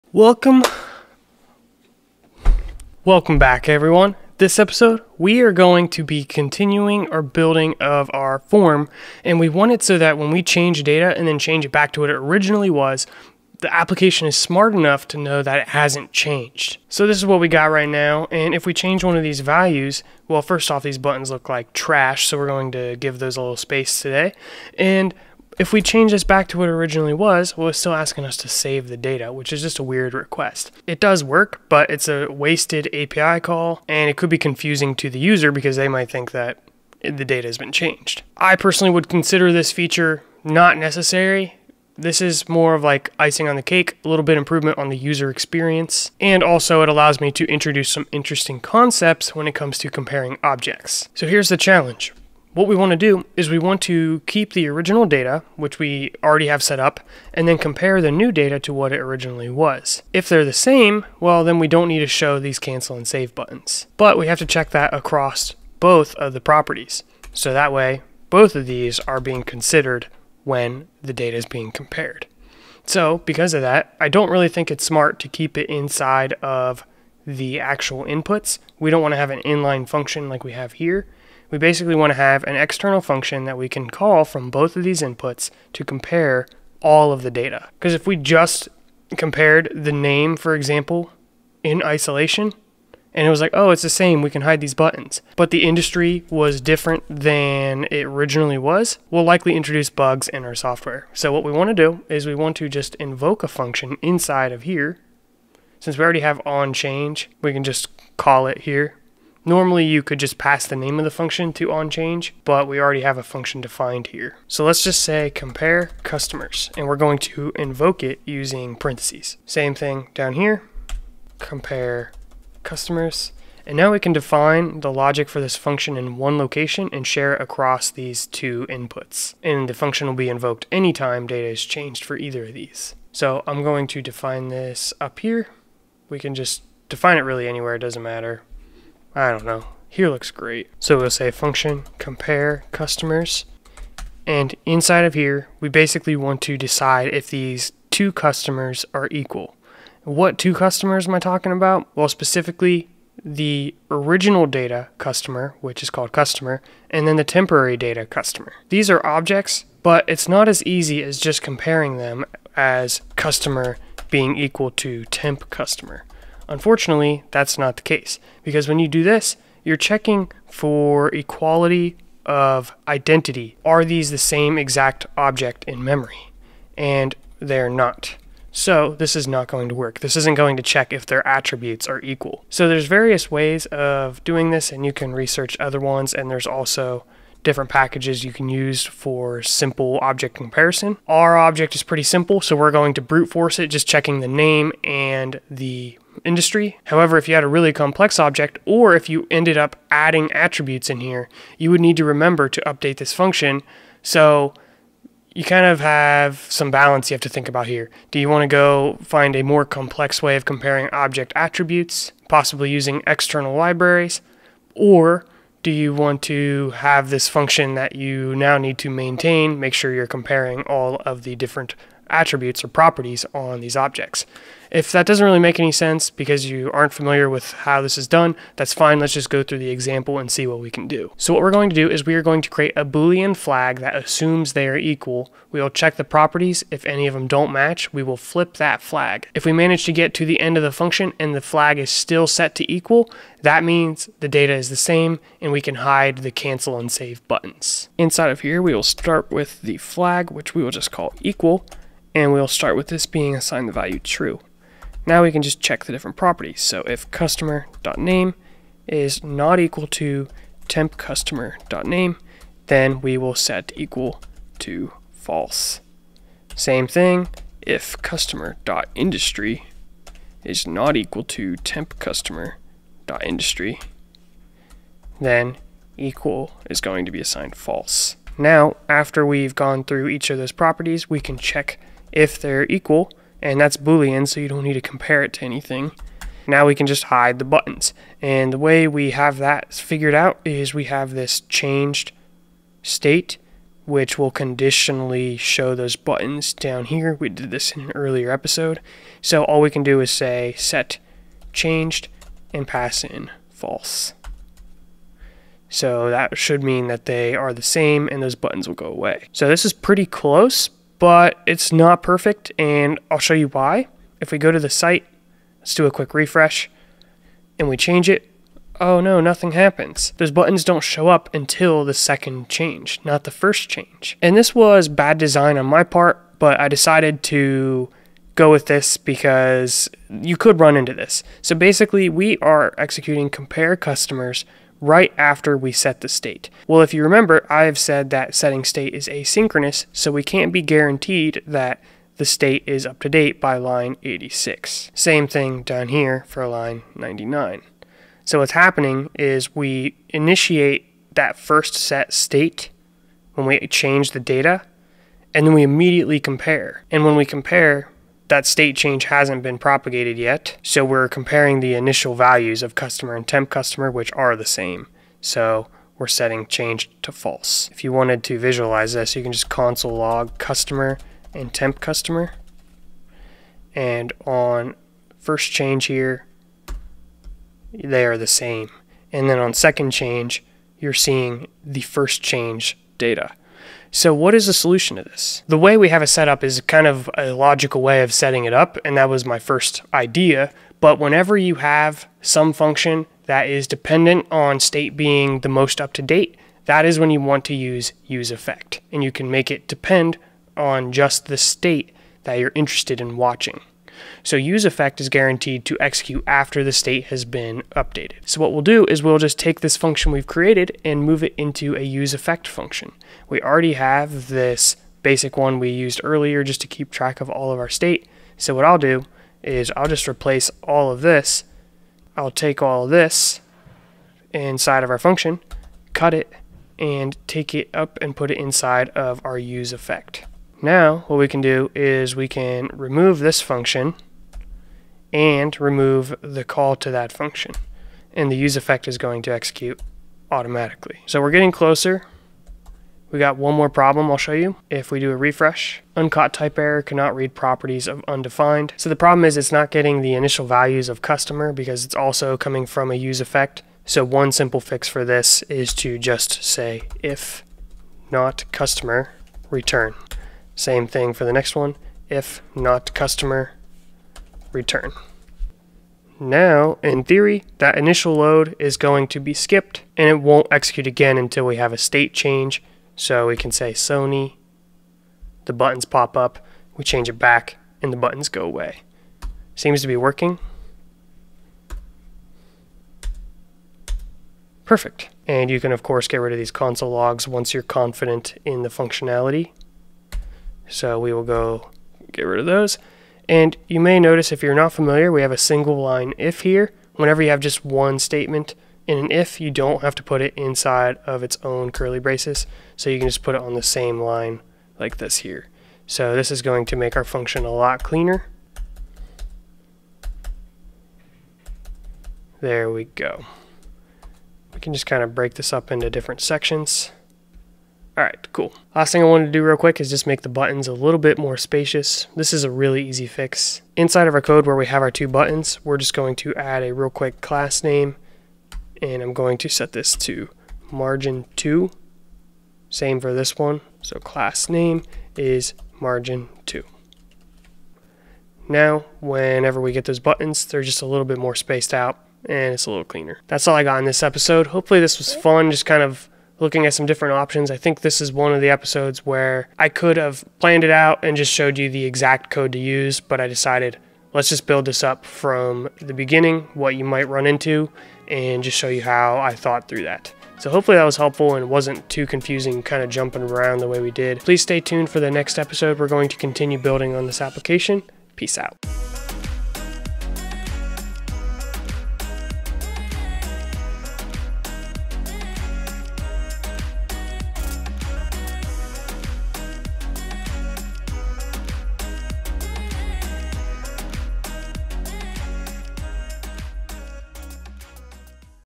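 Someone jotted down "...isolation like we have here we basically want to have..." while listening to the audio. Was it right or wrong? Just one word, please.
wrong.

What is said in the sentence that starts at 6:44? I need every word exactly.
So use effect is guaranteed to execute after the state has been updated.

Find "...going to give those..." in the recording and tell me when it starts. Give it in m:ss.
0:22.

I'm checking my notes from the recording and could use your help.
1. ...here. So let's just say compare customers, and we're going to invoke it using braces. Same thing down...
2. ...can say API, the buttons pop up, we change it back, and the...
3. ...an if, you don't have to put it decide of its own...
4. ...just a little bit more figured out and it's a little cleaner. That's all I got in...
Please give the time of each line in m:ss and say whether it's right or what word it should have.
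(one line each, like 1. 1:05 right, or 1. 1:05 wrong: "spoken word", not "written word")
1. 1:54 wrong: "parentheses", not "braces"
2. 7:53 wrong: "Sony", not "API"
3. 8:18 wrong: "inside", not "decide"
4. 9:00 wrong: "spaced", not "figured".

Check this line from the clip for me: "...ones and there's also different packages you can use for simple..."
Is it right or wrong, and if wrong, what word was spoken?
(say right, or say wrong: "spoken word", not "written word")
right.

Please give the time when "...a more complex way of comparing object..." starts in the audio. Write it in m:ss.
3:29.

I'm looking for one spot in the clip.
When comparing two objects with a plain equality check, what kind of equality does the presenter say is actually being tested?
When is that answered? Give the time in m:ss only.
2:51.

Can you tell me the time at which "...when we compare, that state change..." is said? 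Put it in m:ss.
5:57.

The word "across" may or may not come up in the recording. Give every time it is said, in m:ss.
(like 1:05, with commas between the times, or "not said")
1:04, 2:07.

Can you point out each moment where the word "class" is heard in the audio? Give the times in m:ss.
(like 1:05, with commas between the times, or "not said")
8:47, 8:53.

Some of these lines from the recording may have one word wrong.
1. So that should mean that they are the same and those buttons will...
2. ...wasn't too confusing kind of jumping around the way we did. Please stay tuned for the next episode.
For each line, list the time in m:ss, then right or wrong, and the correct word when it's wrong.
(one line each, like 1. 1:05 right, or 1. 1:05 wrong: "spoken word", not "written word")
1. 5:05 right
2. 9:21 right.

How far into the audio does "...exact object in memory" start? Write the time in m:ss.
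2:54.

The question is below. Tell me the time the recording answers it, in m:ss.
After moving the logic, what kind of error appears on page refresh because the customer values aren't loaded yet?
7:25.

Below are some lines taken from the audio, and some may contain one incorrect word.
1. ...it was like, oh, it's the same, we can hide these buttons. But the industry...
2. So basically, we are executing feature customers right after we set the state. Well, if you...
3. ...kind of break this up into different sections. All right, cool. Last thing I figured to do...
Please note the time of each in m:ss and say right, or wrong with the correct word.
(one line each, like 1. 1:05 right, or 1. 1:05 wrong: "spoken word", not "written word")
1. 1:33 right
2. 5:31 wrong: "compare", not "feature"
3. 8:34 wrong: "wanted", not "figured".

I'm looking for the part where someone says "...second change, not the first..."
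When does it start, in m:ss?
5:21.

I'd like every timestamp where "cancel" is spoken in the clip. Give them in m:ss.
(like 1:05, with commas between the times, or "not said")
1:02, 4:06.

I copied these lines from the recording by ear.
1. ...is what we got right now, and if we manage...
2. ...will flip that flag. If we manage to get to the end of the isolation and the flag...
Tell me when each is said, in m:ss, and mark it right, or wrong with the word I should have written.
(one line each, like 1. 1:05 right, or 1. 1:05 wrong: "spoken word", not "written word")
1. 0:17 wrong: "change", not "manage"
2. 3:58 wrong: "function", not "isolation".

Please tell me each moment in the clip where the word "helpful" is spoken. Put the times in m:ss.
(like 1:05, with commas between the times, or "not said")
9:20.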